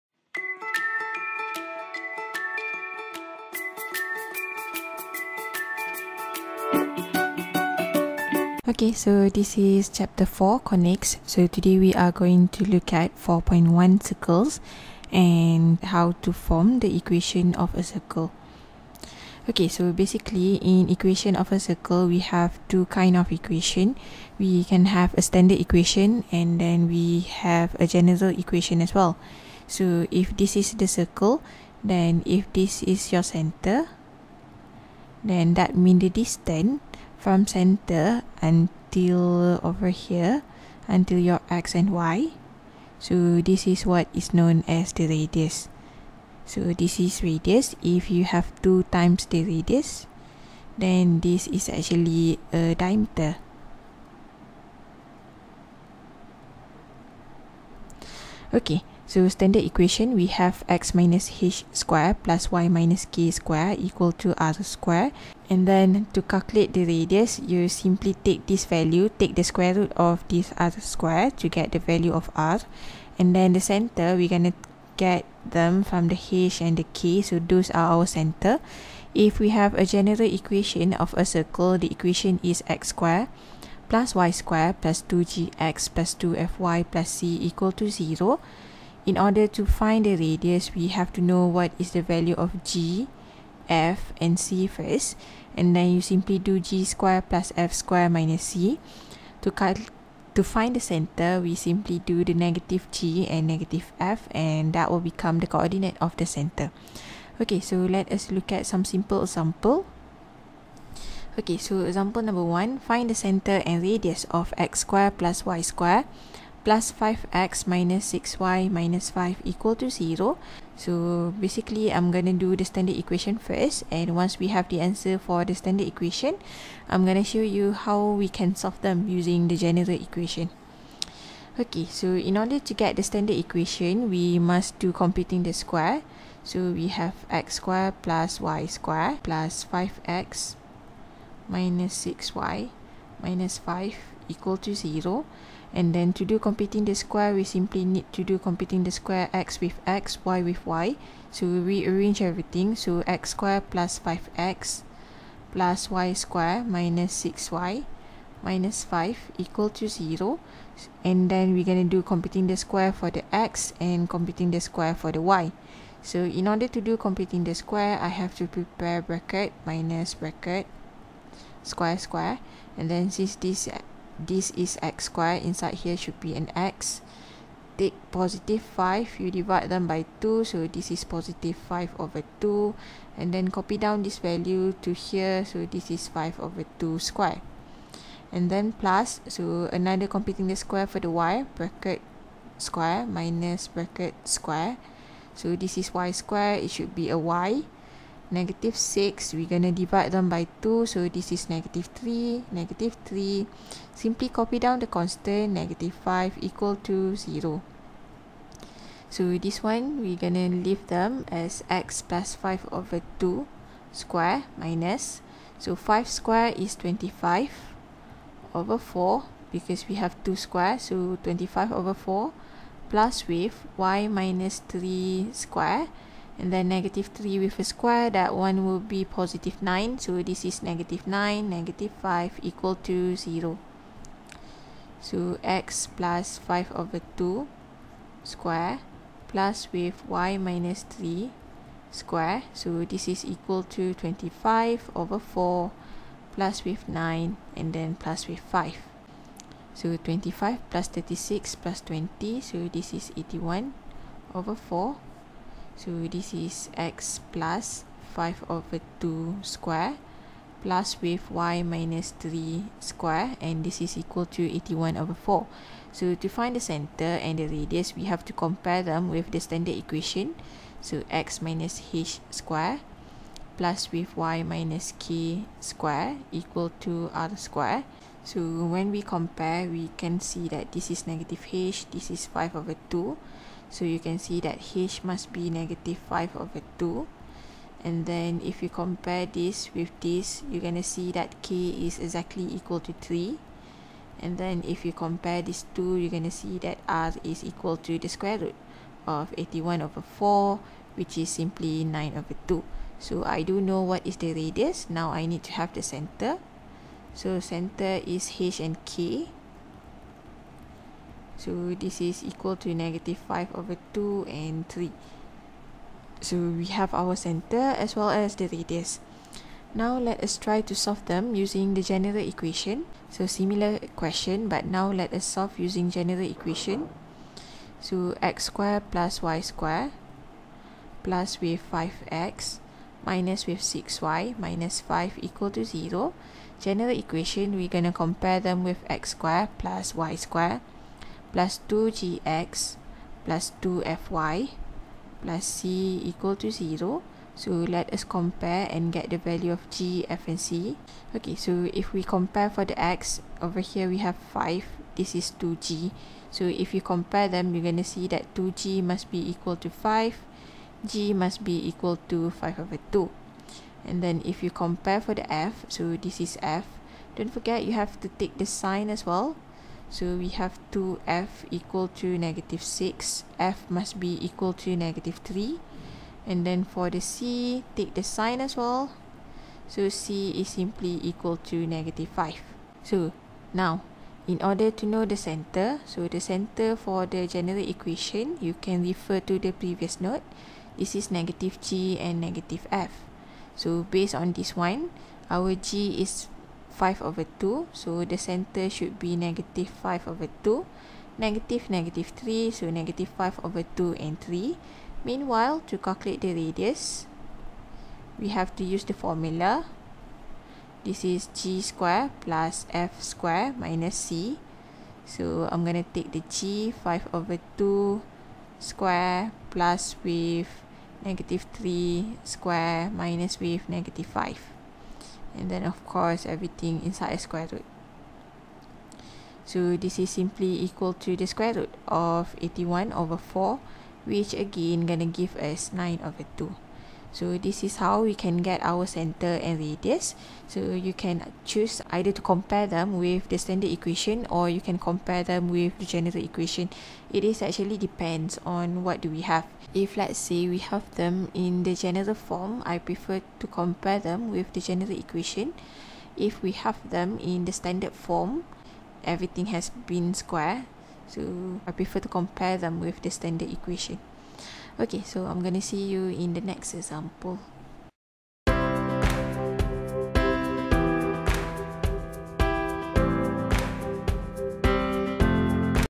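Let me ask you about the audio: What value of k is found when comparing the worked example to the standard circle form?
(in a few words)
3.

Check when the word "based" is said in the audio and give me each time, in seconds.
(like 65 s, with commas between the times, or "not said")
393 s.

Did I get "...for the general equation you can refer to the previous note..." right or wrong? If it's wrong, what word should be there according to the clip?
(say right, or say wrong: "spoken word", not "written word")
right.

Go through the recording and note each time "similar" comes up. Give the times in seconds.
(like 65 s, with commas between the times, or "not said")
323 s.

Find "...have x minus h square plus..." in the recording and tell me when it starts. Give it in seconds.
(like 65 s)
60 s.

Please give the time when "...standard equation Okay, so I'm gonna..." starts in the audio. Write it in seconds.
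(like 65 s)
463 s.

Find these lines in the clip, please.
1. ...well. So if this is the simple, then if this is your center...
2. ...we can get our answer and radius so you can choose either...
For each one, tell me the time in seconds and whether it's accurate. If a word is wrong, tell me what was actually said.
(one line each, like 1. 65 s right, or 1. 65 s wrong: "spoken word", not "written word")
1. 28 s wrong: "circle", not "simple"
2. 438 s wrong: "center", not "answer".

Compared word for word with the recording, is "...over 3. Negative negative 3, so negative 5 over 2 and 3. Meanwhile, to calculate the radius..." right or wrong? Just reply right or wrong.
wrong.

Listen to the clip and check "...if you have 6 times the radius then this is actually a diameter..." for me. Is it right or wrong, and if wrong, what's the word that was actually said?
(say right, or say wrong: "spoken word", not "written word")
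wrong: "2", not "6".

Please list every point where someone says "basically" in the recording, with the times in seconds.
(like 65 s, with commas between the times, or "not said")
19 s, 121 s.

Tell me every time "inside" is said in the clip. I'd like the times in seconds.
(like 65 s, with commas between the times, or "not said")
175 s, 426 s.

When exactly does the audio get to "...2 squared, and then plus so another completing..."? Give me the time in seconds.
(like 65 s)
186 s.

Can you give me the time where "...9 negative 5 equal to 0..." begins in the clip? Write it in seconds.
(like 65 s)
231 s.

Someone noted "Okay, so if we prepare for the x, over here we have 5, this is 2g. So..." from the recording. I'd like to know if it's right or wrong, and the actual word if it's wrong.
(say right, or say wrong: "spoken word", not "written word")
wrong: "compare", not "prepare".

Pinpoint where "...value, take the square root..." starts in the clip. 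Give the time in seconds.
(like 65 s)
68 s.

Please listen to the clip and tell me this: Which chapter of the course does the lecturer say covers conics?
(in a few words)
4.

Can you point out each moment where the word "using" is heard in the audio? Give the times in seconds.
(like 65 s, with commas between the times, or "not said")
129 s, 321 s, 325 s.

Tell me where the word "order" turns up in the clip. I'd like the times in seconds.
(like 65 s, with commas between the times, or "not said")
89 s, 132 s, 166 s, 384 s.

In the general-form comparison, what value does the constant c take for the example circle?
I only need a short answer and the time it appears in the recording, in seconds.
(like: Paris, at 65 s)
-5, at 379 s.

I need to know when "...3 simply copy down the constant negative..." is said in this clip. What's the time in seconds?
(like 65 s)
203 s.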